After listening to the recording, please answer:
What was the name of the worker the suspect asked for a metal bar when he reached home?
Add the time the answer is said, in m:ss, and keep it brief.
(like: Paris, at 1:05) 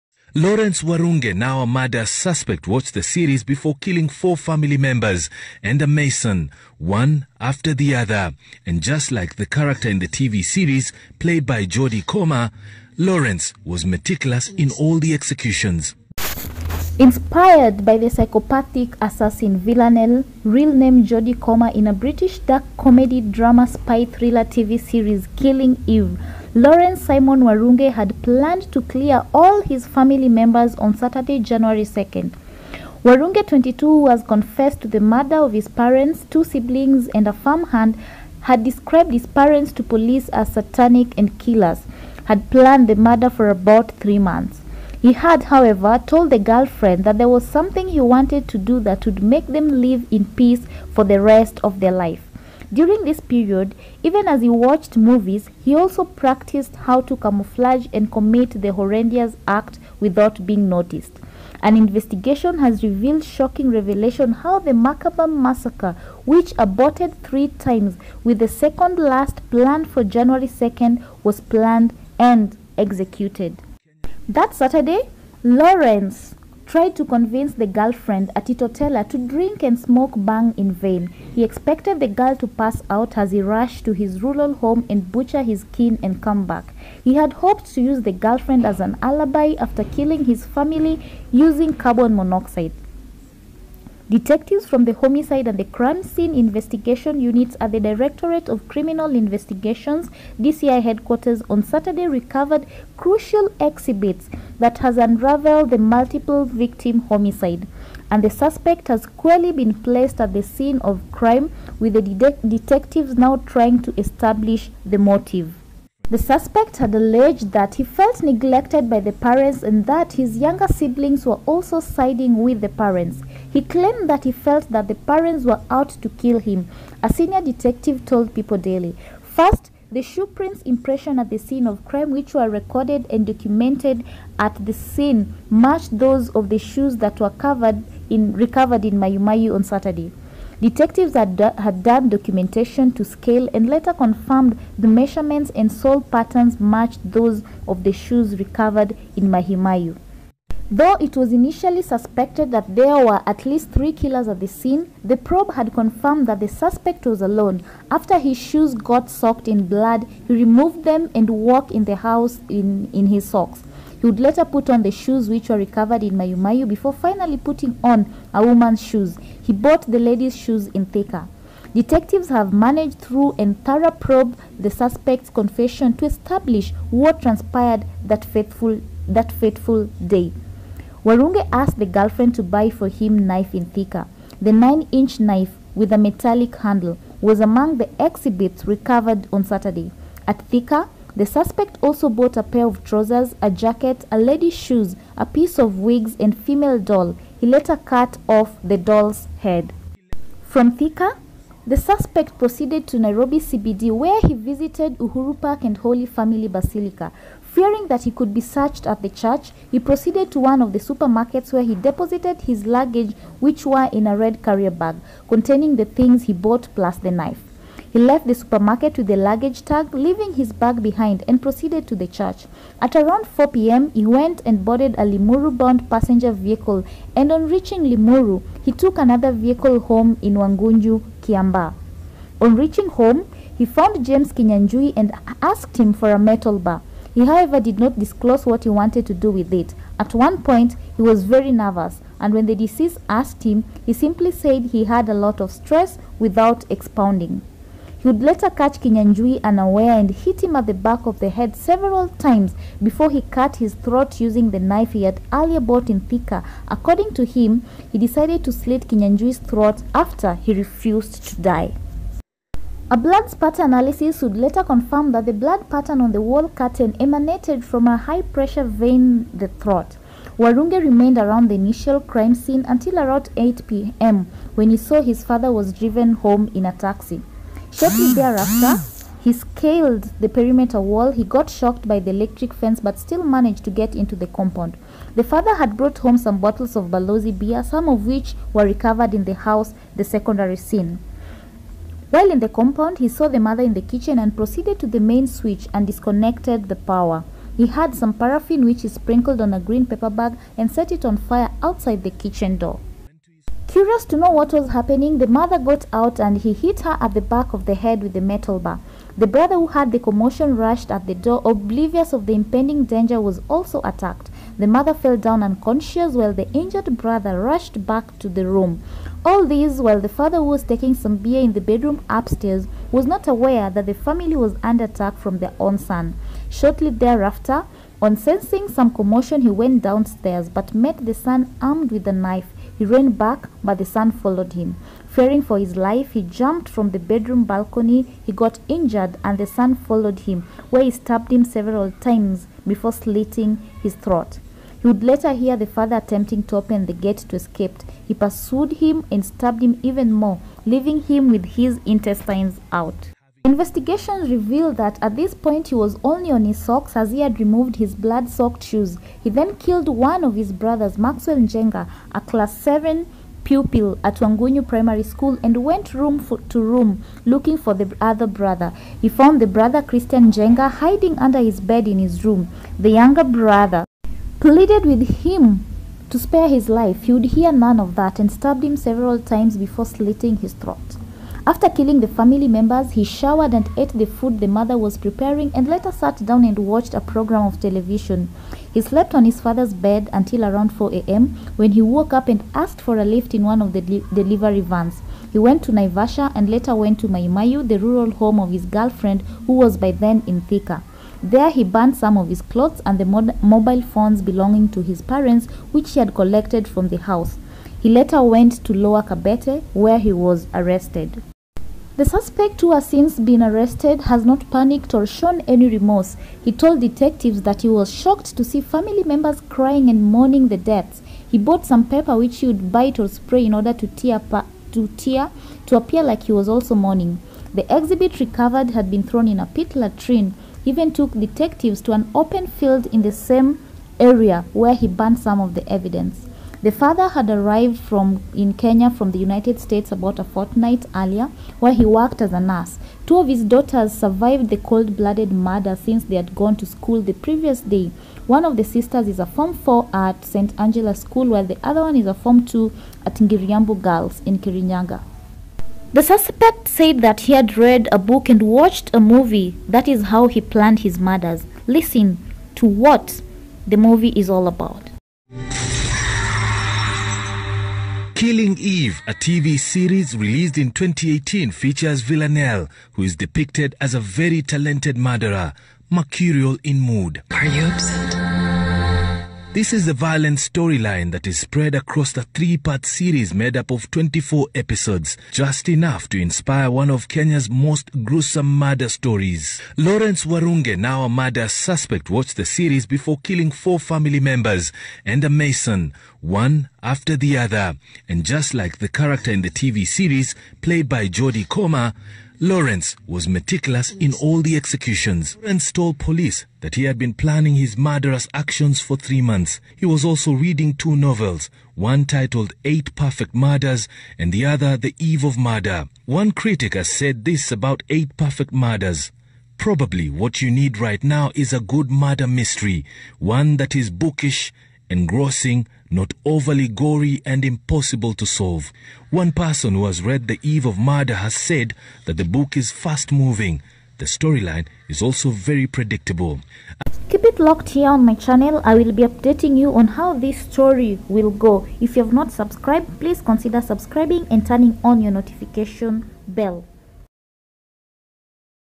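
James Kinyanjui, at 3:54.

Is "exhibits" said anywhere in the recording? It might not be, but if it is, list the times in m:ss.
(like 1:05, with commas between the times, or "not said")
1:43, 3:07, 7:07.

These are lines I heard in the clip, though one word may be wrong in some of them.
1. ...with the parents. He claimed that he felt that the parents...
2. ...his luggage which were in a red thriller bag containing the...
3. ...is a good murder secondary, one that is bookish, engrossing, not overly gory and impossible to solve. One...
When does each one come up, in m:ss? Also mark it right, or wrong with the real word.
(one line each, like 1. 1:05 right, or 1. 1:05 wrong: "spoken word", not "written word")
1. 2:02 right
2. 3:32 wrong: "carrier", not "thriller"
3. 8:41 wrong: "mystery", not "secondary".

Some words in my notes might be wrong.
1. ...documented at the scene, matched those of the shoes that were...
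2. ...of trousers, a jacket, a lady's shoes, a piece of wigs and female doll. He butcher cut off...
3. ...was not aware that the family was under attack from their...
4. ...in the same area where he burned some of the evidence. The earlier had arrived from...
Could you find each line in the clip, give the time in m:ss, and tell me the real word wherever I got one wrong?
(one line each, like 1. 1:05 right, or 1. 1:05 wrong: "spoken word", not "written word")
1. 2:13 right
2. 3:12 wrong: "later", not "butcher"
3. 5:22 right
4. 7:12 wrong: "father", not "earlier".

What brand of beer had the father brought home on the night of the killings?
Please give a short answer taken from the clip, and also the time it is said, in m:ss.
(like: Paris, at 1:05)
Balozi, at 4:46.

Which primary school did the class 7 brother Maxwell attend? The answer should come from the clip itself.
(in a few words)
Wangunyu Primary School.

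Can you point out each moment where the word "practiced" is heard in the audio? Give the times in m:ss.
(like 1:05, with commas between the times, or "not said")
0:56.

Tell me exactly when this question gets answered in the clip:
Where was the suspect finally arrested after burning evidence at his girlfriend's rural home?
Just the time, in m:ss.
6:48.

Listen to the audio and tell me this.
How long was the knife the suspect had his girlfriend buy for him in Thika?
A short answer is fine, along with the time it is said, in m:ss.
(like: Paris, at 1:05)
9-inch, at 3:04.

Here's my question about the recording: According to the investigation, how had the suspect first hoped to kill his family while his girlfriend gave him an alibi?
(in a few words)
carbon monoxide.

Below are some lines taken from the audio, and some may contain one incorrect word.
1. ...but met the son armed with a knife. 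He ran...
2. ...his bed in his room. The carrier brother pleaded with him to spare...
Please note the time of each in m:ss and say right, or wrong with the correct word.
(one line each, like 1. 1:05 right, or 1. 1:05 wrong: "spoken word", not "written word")
1. 5:30 right
2. 6:11 wrong: "younger", not "carrier".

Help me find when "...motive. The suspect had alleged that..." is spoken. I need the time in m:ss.
1:54.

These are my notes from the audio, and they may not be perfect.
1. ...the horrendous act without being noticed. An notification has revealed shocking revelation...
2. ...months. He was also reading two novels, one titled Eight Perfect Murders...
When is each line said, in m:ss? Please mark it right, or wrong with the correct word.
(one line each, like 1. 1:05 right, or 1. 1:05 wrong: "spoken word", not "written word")
1. 0:58 wrong: "investigation", not "notification"
2. 8:29 right.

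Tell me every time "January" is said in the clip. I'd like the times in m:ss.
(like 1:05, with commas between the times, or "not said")
0:31, 1:10.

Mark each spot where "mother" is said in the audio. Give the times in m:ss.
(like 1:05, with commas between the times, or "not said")
4:53, 5:05, 5:14, 6:24.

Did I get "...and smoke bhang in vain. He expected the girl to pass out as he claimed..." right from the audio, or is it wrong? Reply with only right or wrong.
wrong.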